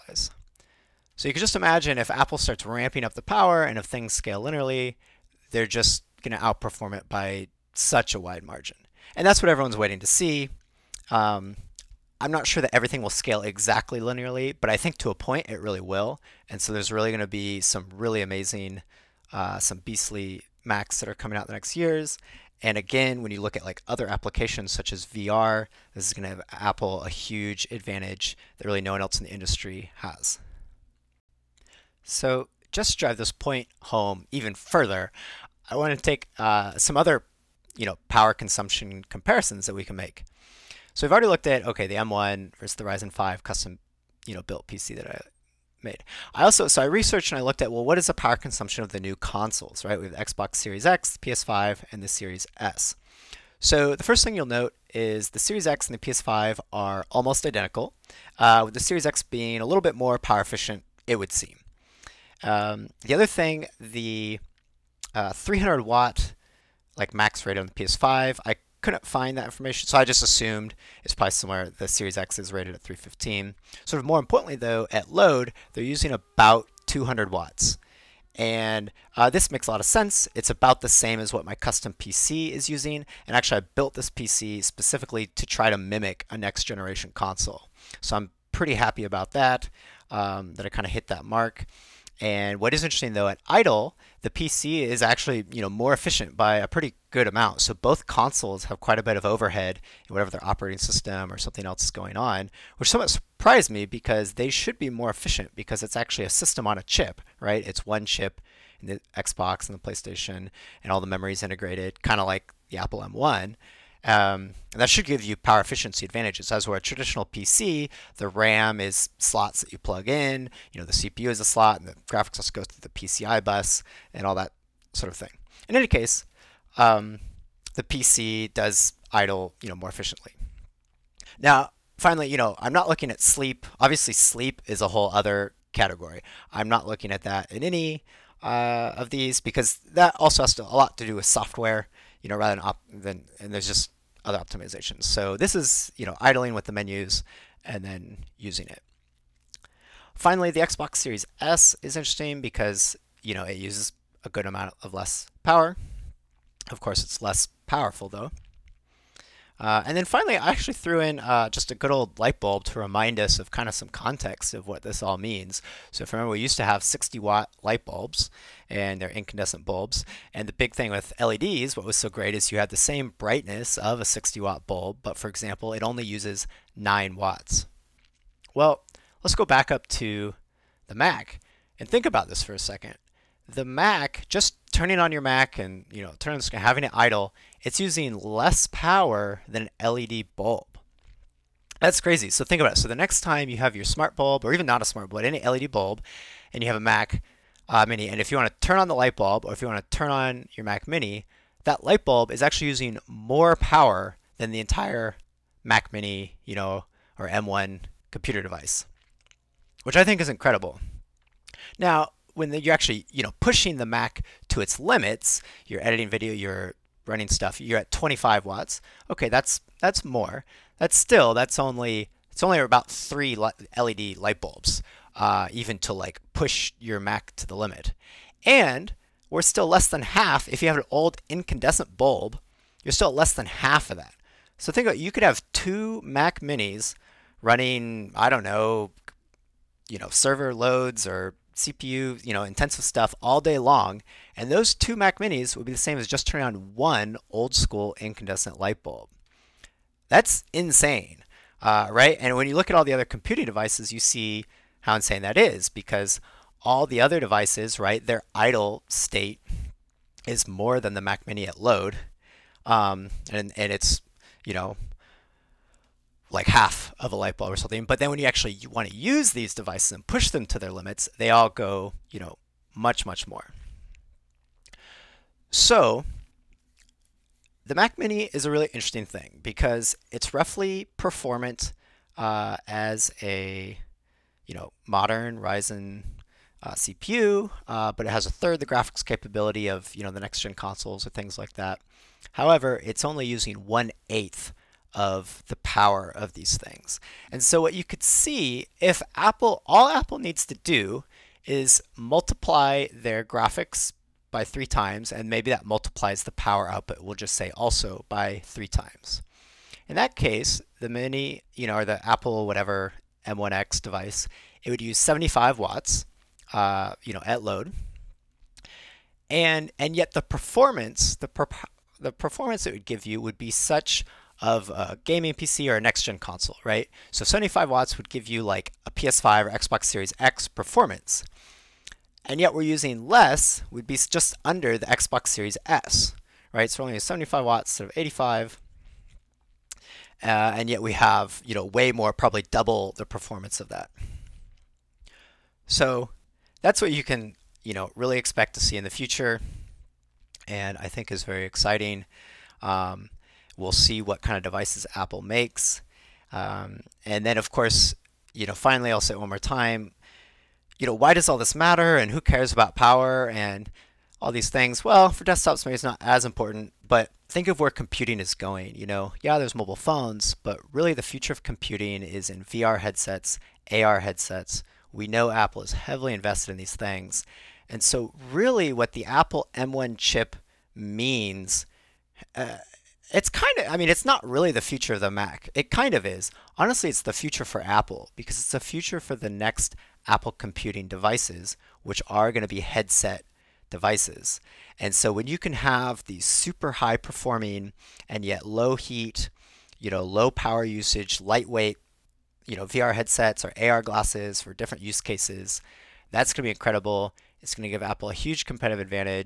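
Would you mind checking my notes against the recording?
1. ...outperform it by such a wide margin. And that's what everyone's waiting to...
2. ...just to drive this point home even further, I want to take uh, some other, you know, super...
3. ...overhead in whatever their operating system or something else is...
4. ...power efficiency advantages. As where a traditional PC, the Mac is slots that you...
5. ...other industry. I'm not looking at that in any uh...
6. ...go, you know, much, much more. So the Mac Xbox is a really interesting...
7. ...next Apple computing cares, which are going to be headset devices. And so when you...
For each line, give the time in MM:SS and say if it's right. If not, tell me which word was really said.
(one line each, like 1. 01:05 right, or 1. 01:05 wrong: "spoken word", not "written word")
1. 00:06 right
2. 00:32 wrong: "power", not "super"
3. 01:39 right
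4. 01:55 wrong: "RAM", not "Mac"
5. 02:15 wrong: "category", not "industry"
6. 04:31 wrong: "Mini", not "Xbox"
7. 06:29 wrong: "devices", not "cares".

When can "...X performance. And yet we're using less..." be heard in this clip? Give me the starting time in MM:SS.
05:30.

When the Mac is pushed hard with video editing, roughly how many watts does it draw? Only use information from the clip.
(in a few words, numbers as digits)
25 watts.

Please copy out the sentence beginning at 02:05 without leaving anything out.
In any case, um, the PC does idle, you know, more efficiently.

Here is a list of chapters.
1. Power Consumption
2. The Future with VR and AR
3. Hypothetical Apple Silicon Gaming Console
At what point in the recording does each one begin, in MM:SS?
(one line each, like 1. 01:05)
1. 00:31
2. 05:57
3. 04:38.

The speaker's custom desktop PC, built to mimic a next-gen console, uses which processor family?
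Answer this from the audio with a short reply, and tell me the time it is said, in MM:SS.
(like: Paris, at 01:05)
Ryzen 5, at 00:42.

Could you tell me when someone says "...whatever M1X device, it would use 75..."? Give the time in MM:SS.
05:12.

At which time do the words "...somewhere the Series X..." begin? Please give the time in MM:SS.
01:11.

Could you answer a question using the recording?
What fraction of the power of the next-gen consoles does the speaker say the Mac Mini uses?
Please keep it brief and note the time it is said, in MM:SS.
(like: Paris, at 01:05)
one eighth, at 04:53.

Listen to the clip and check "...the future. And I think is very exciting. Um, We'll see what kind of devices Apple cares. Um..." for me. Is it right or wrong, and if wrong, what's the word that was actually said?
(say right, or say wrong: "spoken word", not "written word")
wrong: "makes", not "cares".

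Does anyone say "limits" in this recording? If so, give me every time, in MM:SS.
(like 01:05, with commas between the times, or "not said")
03:34, 03:47, 04:30.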